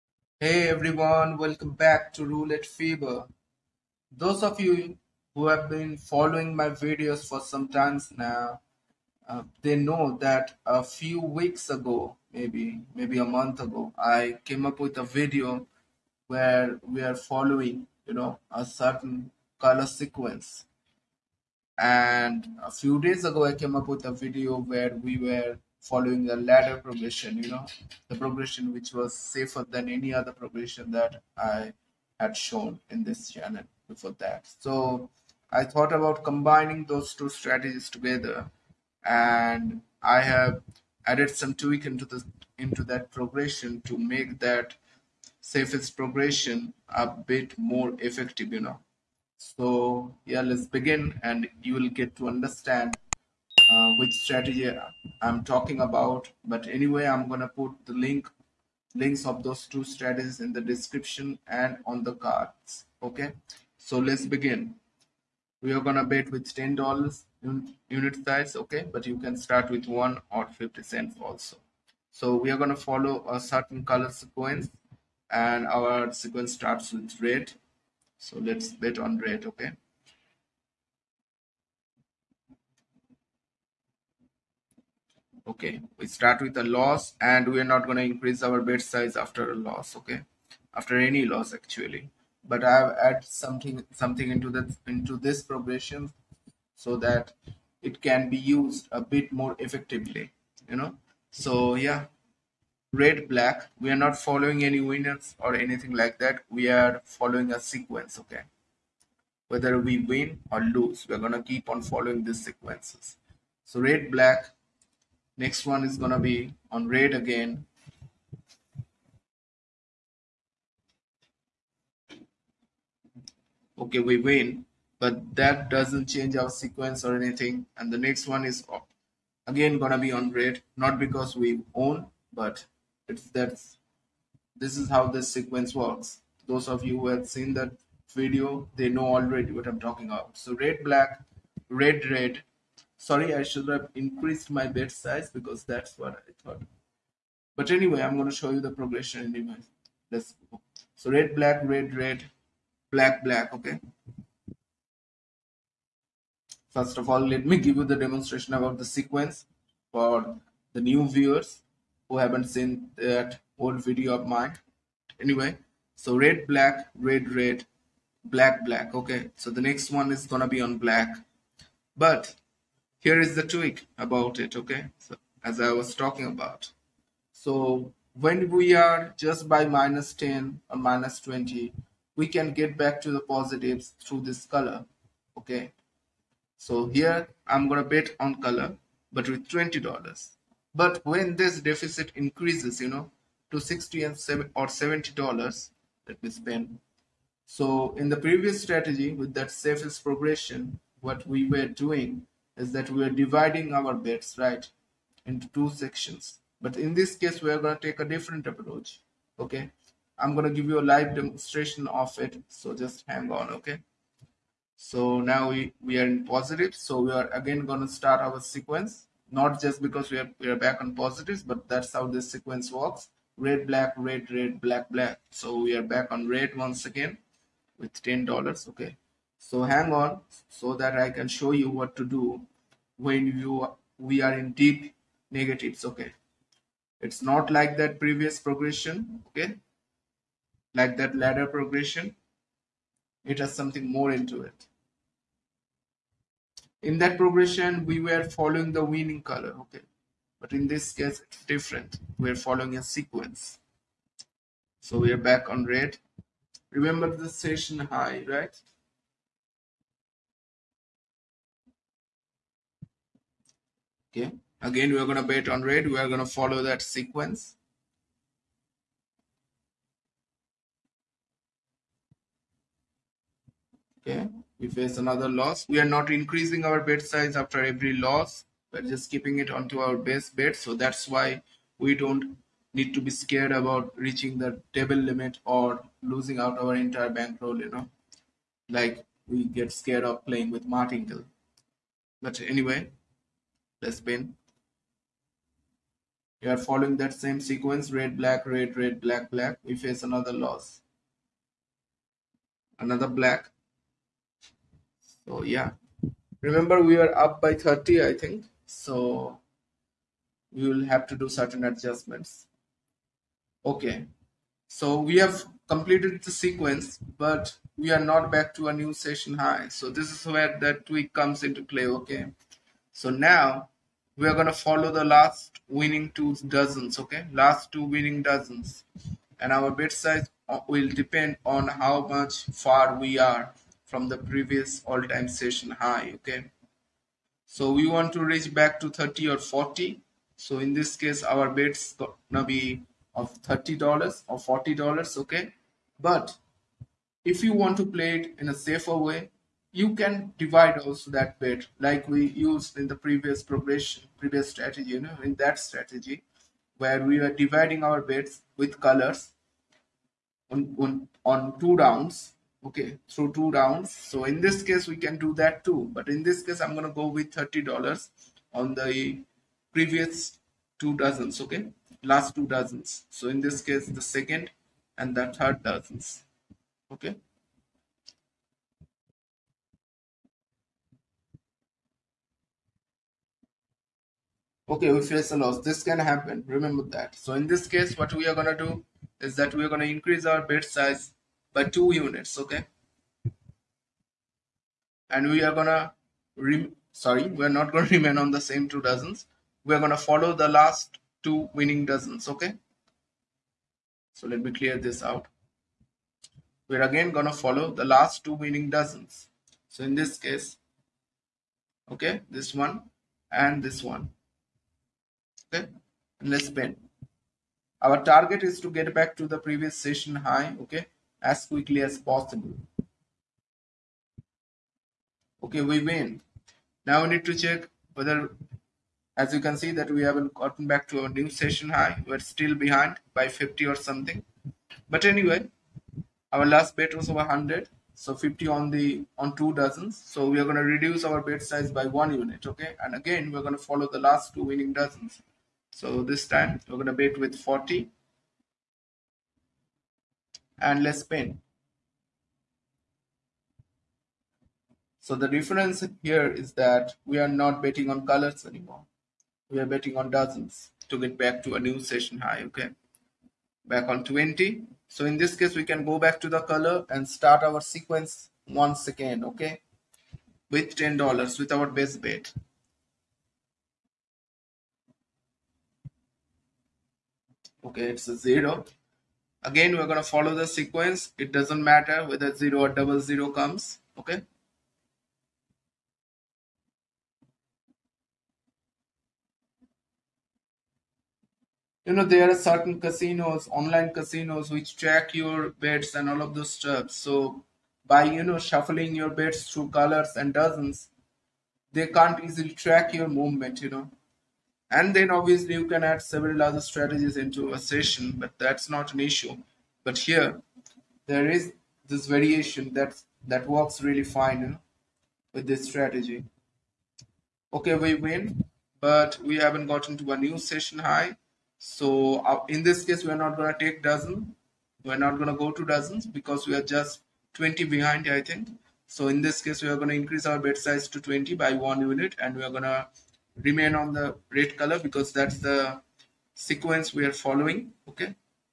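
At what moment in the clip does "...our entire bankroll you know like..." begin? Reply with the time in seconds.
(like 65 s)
286 s.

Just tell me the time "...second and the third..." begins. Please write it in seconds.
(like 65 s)
374 s.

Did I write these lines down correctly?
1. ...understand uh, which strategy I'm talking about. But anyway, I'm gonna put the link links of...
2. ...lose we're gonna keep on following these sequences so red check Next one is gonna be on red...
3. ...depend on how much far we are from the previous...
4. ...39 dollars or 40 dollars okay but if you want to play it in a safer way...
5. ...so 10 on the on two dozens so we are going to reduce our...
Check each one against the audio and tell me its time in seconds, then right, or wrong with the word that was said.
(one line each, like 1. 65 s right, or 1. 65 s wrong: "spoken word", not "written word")
1. 52 s right
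2. 110 s wrong: "black", not "check"
3. 330 s right
4. 343 s wrong: "30", not "39"
5. 437 s wrong: "50", not "10".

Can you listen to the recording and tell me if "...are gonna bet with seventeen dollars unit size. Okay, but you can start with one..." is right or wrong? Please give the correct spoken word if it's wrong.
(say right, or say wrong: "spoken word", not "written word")
wrong: "ten", not "seventeen".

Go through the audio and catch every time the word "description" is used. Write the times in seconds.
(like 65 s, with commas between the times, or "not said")
60 s.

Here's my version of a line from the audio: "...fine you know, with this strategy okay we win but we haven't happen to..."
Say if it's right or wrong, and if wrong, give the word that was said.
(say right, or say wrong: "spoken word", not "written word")
wrong: "gotten", not "happen".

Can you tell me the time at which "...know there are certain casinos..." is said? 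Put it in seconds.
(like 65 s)
491 s.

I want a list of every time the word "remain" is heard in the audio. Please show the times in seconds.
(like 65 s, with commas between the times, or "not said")
397 s, 533 s.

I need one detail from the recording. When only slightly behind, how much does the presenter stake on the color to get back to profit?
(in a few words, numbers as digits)
$20.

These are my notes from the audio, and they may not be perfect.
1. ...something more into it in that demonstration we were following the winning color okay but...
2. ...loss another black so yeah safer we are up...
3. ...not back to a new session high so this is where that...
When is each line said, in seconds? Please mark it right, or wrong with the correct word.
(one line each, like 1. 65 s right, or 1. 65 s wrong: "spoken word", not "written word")
1. 243 s wrong: "progression", not "demonstration"
2. 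300 s wrong: "remember", not "safer"
3. 318 s right.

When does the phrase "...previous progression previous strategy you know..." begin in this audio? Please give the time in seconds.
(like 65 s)
352 s.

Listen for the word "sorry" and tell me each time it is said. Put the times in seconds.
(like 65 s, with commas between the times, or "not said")
143 s, 396 s.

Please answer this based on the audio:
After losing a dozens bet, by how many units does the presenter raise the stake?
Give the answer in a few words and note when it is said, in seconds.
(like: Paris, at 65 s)
2 units, at 391 s.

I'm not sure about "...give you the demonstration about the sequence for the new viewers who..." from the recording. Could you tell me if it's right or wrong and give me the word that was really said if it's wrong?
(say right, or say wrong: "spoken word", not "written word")
right.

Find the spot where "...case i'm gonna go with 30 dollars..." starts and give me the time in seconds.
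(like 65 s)
366 s.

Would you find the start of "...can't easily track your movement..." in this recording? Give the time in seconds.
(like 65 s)
501 s.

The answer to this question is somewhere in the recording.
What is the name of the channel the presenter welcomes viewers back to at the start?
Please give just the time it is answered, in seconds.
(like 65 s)
2 s.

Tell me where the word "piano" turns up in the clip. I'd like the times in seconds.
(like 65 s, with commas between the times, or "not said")
not said.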